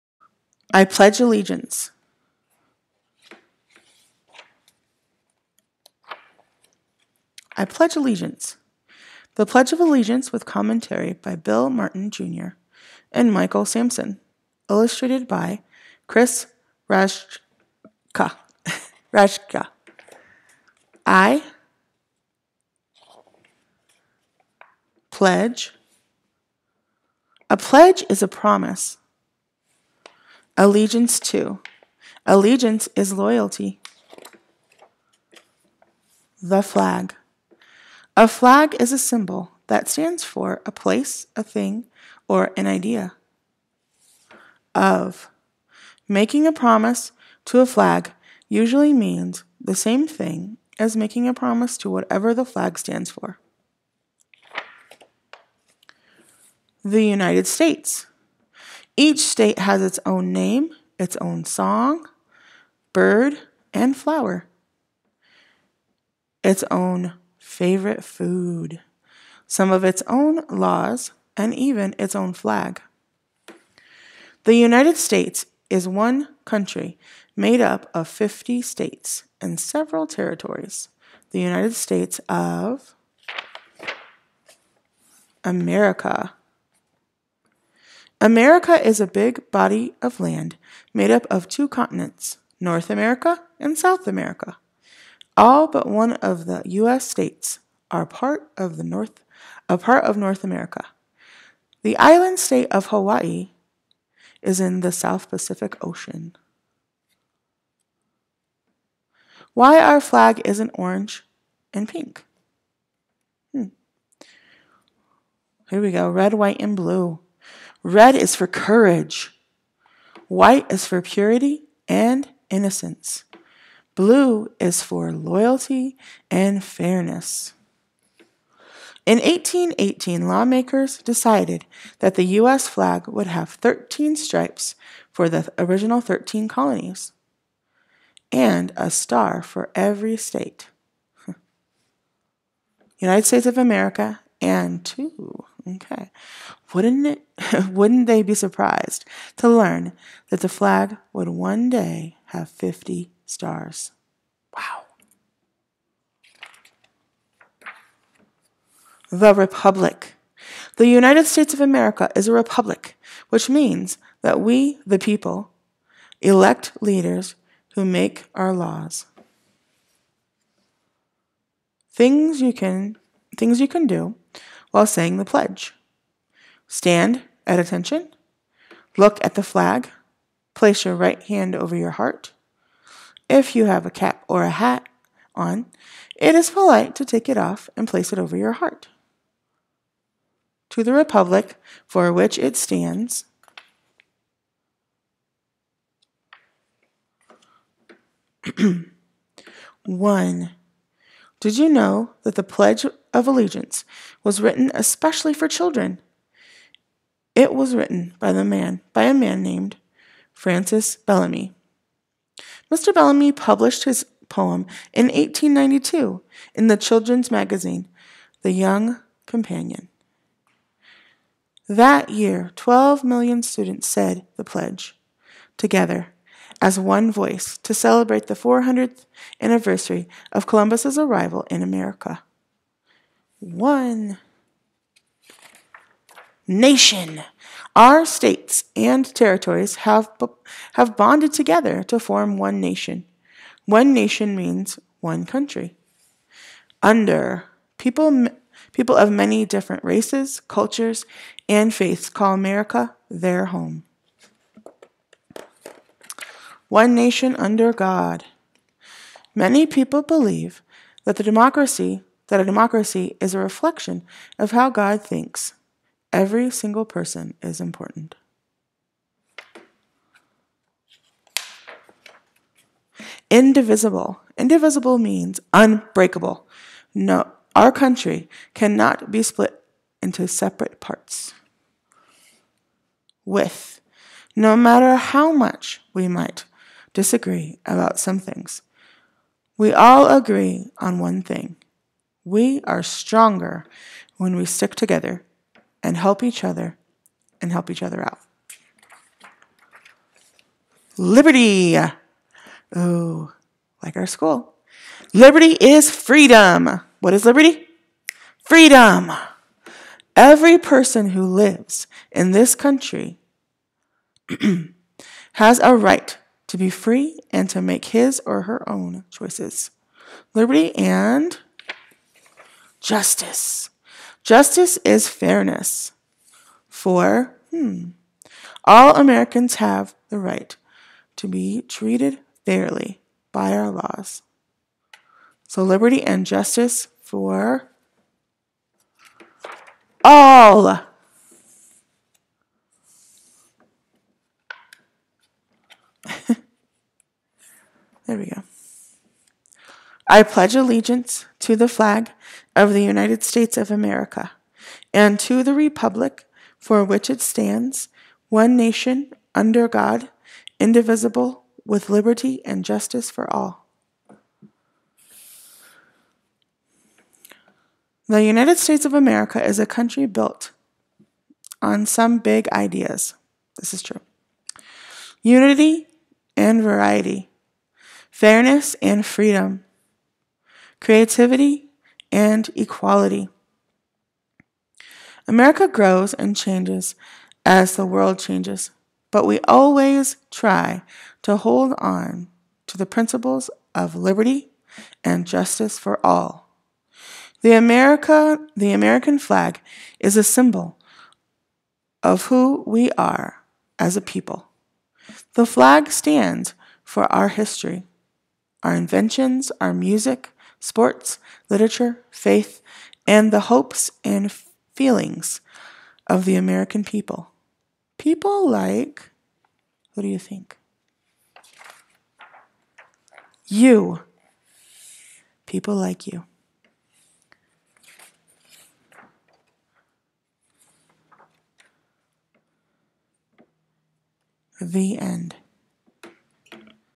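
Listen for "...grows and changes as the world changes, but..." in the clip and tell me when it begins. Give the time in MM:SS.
06:25.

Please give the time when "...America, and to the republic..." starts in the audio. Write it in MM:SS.
05:53.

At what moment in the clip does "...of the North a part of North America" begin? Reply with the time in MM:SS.
01:38.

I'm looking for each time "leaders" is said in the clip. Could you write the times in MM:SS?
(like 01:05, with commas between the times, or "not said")
02:46.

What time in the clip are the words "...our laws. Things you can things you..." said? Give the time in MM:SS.
02:48.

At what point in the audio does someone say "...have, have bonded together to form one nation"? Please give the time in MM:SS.
03:59.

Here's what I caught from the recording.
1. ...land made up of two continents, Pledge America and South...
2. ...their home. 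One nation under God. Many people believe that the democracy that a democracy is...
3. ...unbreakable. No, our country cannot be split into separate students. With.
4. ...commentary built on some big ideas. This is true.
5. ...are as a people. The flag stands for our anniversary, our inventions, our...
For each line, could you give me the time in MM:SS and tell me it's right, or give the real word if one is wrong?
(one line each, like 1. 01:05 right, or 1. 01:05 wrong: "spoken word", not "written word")
1. 01:30 wrong: "North", not "Pledge"
2. 04:13 right
3. 04:35 wrong: "parts", not "students"
4. 06:09 wrong: "country", not "commentary"
5. 06:42 wrong: "history", not "anniversary".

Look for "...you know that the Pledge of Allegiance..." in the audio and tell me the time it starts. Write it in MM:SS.
03:21.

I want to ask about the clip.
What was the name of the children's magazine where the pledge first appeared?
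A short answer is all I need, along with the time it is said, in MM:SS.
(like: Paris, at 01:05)
The Young Companion, at 03:38.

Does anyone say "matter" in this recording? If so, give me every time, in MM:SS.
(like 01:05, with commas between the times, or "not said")
04:44.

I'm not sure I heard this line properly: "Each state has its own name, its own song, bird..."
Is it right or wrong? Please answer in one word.
right.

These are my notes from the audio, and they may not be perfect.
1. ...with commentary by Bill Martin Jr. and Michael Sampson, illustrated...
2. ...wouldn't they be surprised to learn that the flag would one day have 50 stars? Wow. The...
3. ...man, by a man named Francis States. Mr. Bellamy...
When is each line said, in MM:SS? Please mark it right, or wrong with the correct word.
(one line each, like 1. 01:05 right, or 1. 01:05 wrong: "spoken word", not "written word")
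1. 00:10 right
2. 02:27 right
3. 03:28 wrong: "Bellamy", not "States".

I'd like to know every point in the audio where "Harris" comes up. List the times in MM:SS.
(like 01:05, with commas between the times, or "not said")
not said.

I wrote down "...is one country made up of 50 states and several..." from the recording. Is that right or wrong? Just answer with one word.
right.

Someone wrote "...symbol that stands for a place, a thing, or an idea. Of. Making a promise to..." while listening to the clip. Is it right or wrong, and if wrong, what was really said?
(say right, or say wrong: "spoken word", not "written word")
right.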